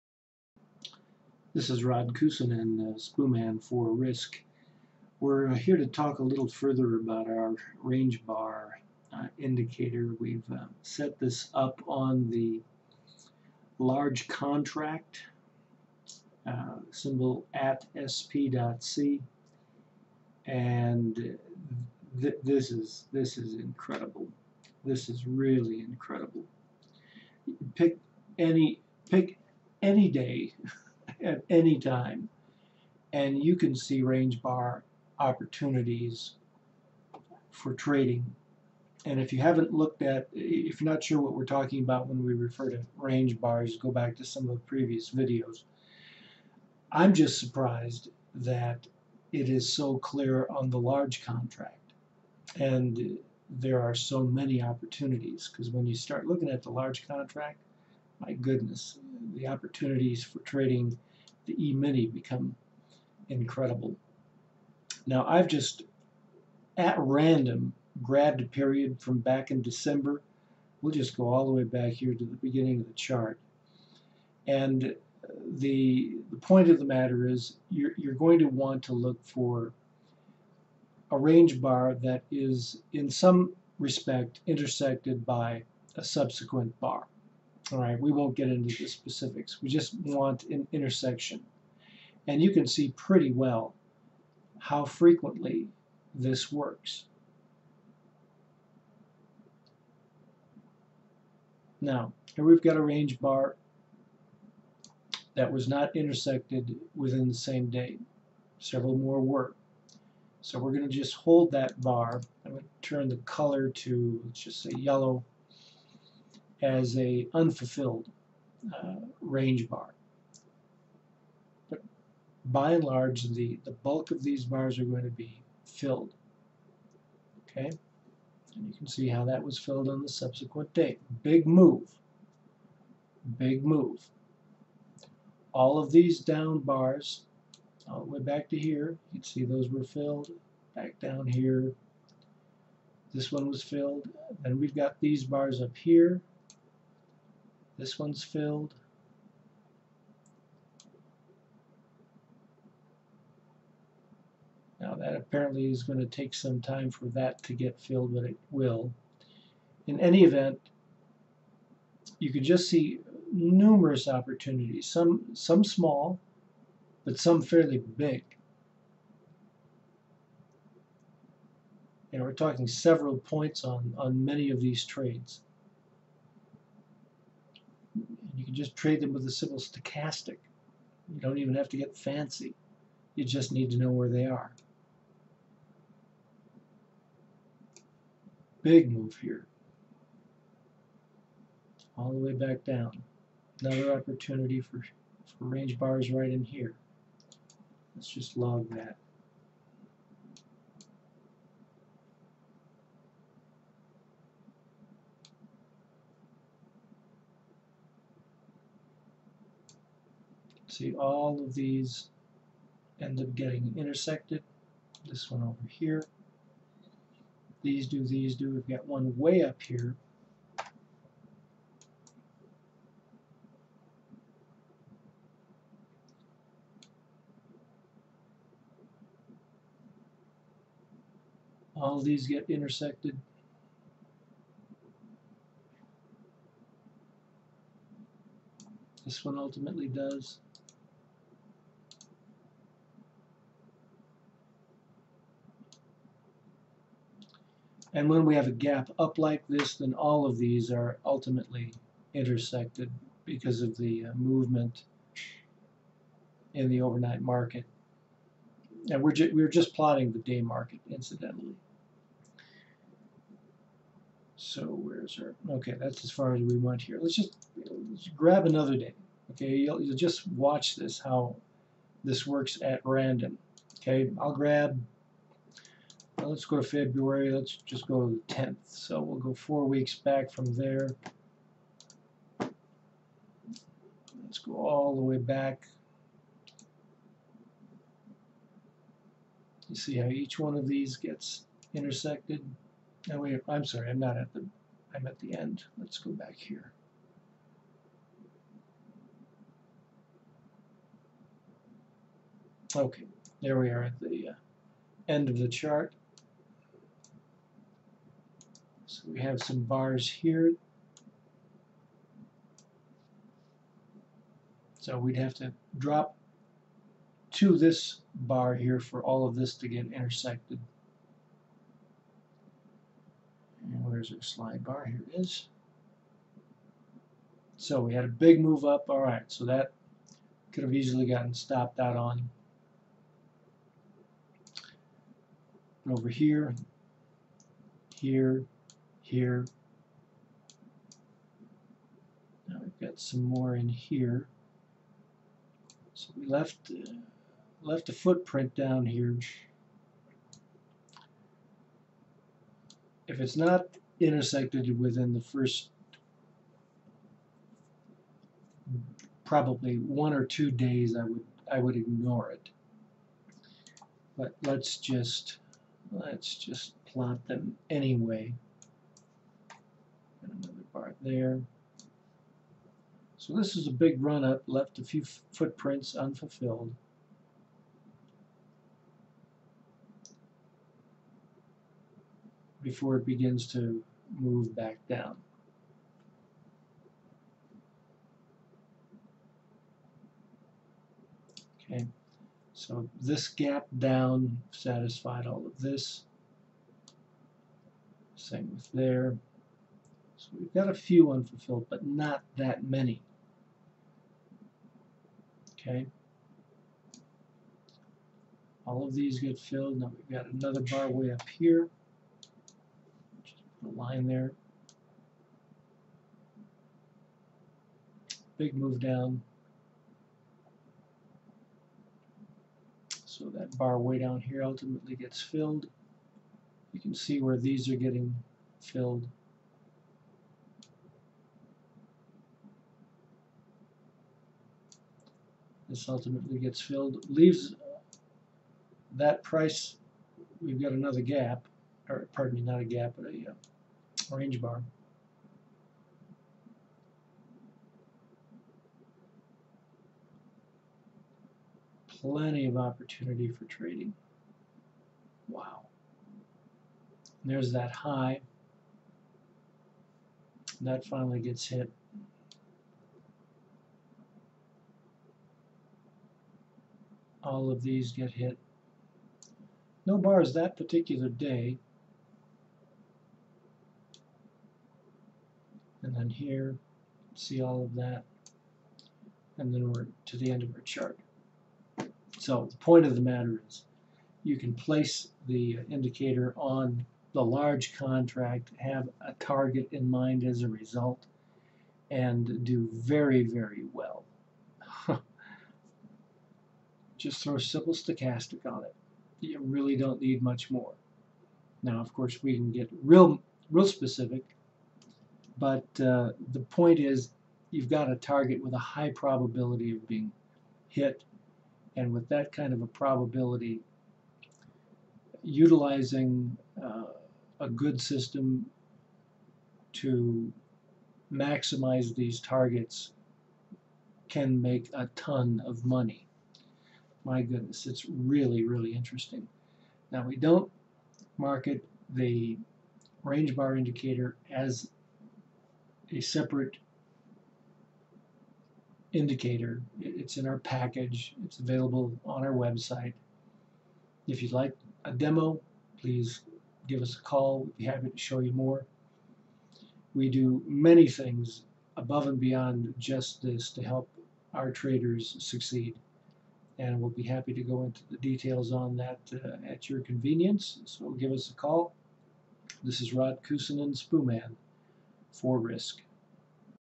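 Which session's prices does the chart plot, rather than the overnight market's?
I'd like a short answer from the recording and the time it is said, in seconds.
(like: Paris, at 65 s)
The day market, at 260 s.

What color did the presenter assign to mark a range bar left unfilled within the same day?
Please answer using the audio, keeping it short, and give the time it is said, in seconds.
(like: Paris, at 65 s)
Yellow, at 114 s.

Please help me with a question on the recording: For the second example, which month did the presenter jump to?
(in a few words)
February.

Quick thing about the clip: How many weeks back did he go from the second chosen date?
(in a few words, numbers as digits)
4.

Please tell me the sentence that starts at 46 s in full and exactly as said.
I'm just surprised that it is so clear on the large contract.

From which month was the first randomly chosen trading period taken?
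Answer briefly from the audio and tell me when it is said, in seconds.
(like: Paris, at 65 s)
December, at 69 s.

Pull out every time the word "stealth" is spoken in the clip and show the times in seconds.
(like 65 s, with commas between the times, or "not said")
not said.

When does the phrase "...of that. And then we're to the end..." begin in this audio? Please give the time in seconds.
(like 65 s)
477 s.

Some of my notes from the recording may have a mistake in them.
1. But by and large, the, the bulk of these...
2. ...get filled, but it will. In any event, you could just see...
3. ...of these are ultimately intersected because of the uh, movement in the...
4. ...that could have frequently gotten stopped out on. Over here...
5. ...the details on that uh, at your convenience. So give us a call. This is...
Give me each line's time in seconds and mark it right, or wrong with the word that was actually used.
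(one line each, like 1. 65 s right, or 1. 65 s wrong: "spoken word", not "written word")
1. 121 s right
2. 157 s right
3. 250 s right
4. 329 s wrong: "easily", not "frequently"
5. 557 s right.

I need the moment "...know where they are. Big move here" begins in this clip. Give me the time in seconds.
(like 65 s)
183 s.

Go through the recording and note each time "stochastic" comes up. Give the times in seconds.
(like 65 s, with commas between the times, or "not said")
179 s, 497 s.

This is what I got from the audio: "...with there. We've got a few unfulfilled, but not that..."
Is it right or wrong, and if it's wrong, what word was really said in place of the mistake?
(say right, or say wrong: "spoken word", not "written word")
right.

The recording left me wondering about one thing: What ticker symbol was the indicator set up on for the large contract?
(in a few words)
sp.c.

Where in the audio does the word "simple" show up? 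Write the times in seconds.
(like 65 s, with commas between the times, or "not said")
179 s, 497 s.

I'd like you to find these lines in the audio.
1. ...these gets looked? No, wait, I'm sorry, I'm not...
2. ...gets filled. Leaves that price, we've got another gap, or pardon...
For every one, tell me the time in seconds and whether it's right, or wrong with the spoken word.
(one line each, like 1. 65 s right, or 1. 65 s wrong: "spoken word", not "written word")
1. 290 s wrong: "intersected", not "looked"
2. 436 s right.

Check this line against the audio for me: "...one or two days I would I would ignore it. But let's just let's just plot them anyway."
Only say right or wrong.
right.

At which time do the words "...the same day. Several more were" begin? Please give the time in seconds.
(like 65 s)
107 s.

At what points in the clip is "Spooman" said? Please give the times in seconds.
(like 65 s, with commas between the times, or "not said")
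2 s, 563 s.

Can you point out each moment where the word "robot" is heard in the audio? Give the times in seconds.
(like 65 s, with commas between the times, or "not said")
not said.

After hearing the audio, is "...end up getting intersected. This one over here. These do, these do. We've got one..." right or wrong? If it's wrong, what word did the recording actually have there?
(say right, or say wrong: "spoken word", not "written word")
right.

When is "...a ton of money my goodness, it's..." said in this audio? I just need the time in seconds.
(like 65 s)
524 s.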